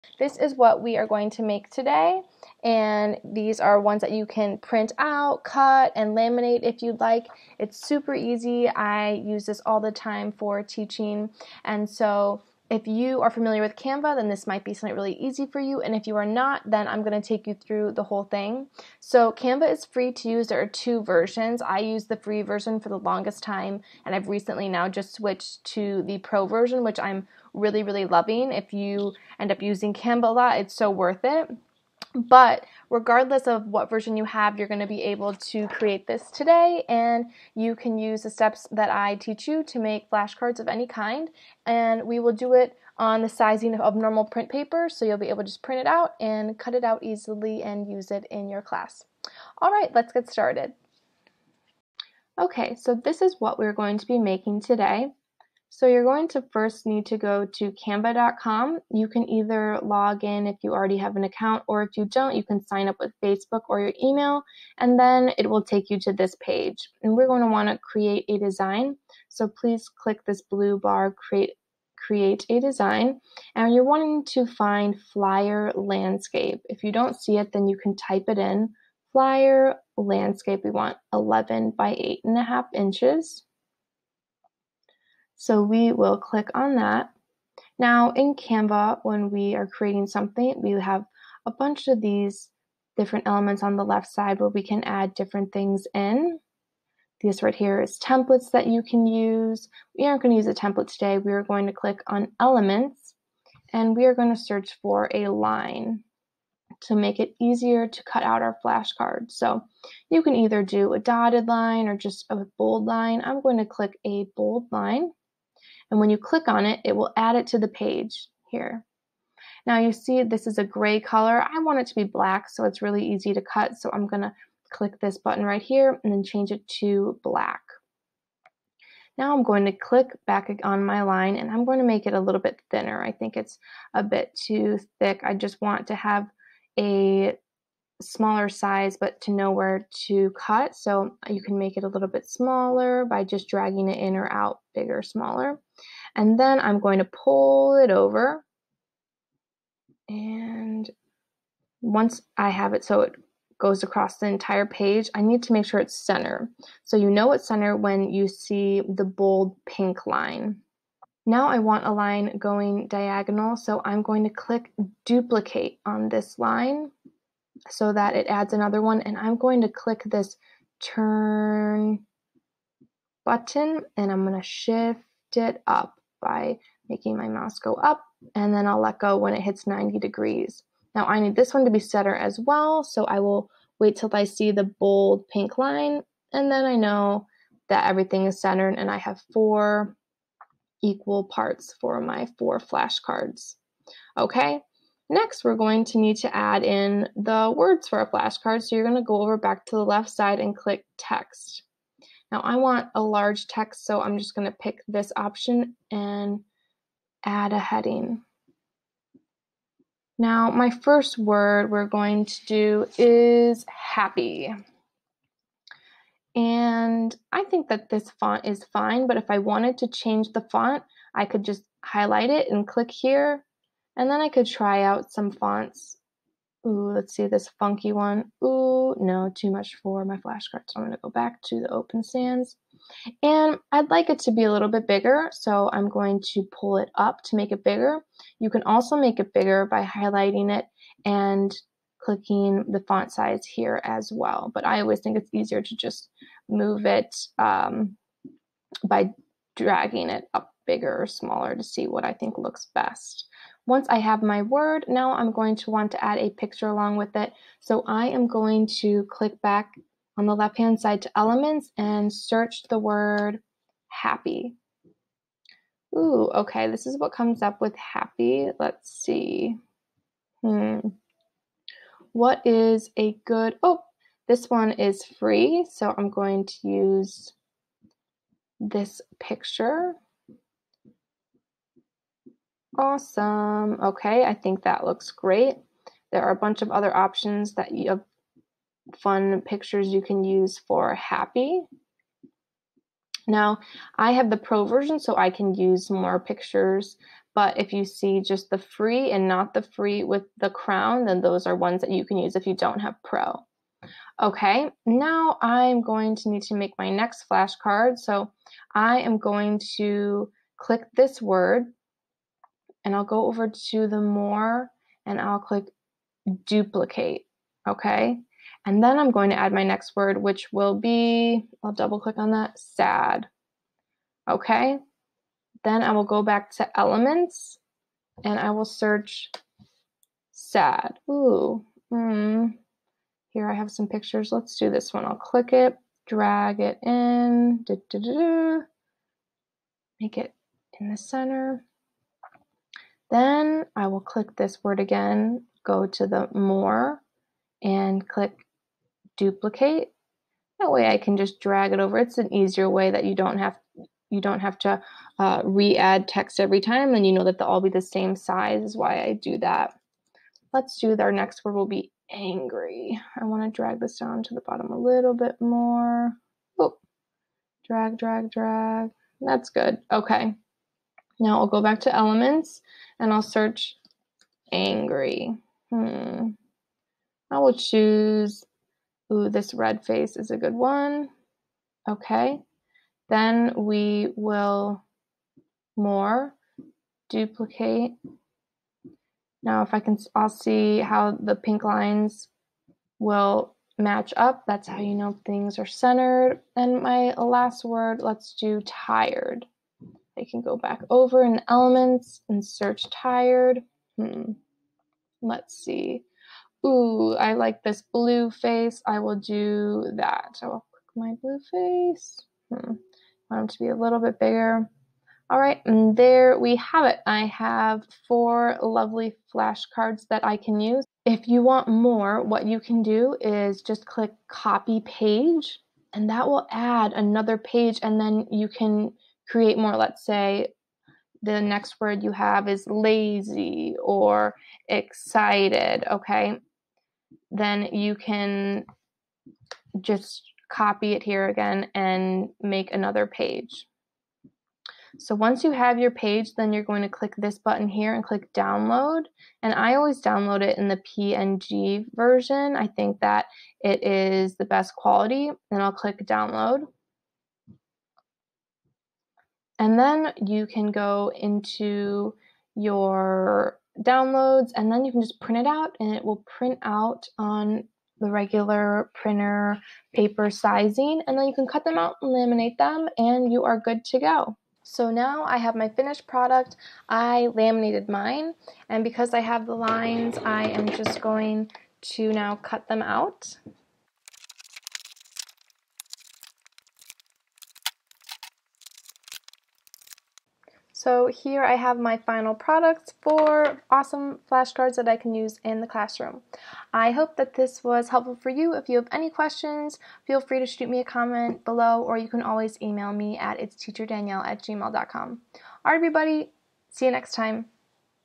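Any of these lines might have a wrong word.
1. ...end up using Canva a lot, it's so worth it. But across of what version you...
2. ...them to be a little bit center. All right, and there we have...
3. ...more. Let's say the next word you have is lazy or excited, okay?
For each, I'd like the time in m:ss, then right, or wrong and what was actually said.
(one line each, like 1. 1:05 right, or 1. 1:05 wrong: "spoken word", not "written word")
1. 0:29 wrong: "regardless", not "across"
2. 6:53 wrong: "bigger", not "center"
3. 7:09 right.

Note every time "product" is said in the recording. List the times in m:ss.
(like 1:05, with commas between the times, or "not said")
7:56, 8:12.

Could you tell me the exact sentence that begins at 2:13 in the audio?
I think it's a bit too thick.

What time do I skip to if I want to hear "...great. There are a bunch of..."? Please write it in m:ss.
4:45.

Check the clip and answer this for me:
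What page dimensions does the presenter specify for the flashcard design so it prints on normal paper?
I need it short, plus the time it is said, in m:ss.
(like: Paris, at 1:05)
11 by 8 and a half inches, at 1:21.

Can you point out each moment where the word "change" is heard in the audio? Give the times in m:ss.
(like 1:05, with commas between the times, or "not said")
2:06, 3:39.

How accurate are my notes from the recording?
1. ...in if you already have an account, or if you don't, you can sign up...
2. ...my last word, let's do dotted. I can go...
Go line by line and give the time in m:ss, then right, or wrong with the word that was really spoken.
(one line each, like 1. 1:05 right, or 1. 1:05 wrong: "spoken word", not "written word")
1. 1:00 right
2. 6:36 wrong: "tired", not "dotted".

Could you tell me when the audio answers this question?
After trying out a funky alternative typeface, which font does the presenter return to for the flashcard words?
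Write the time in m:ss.
3:51.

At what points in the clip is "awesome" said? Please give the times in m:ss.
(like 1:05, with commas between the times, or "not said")
4:42, 8:13.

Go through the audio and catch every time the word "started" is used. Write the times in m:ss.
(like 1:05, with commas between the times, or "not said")
0:50.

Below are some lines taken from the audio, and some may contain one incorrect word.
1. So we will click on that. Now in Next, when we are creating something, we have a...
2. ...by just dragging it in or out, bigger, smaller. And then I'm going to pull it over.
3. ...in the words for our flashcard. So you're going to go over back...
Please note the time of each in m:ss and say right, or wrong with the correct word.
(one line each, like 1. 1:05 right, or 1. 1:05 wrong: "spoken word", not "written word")
1. 1:25 wrong: "Canva", not "Next"
2. 2:23 right
3. 3:16 right.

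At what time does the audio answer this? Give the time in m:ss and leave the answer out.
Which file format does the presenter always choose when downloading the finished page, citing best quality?
7:30.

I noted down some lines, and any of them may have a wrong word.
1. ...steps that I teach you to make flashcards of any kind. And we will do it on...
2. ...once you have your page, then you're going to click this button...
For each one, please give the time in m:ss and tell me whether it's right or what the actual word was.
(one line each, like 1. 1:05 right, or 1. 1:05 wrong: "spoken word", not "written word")
1. 0:38 right
2. 7:25 right.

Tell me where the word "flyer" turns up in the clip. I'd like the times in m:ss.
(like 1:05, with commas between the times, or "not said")
1:15, 1:19.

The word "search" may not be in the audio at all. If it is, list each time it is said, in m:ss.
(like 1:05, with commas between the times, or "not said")
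1:44, 4:22, 5:28, 6:13, 6:42.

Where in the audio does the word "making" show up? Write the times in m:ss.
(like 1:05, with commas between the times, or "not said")
0:54, 2:56.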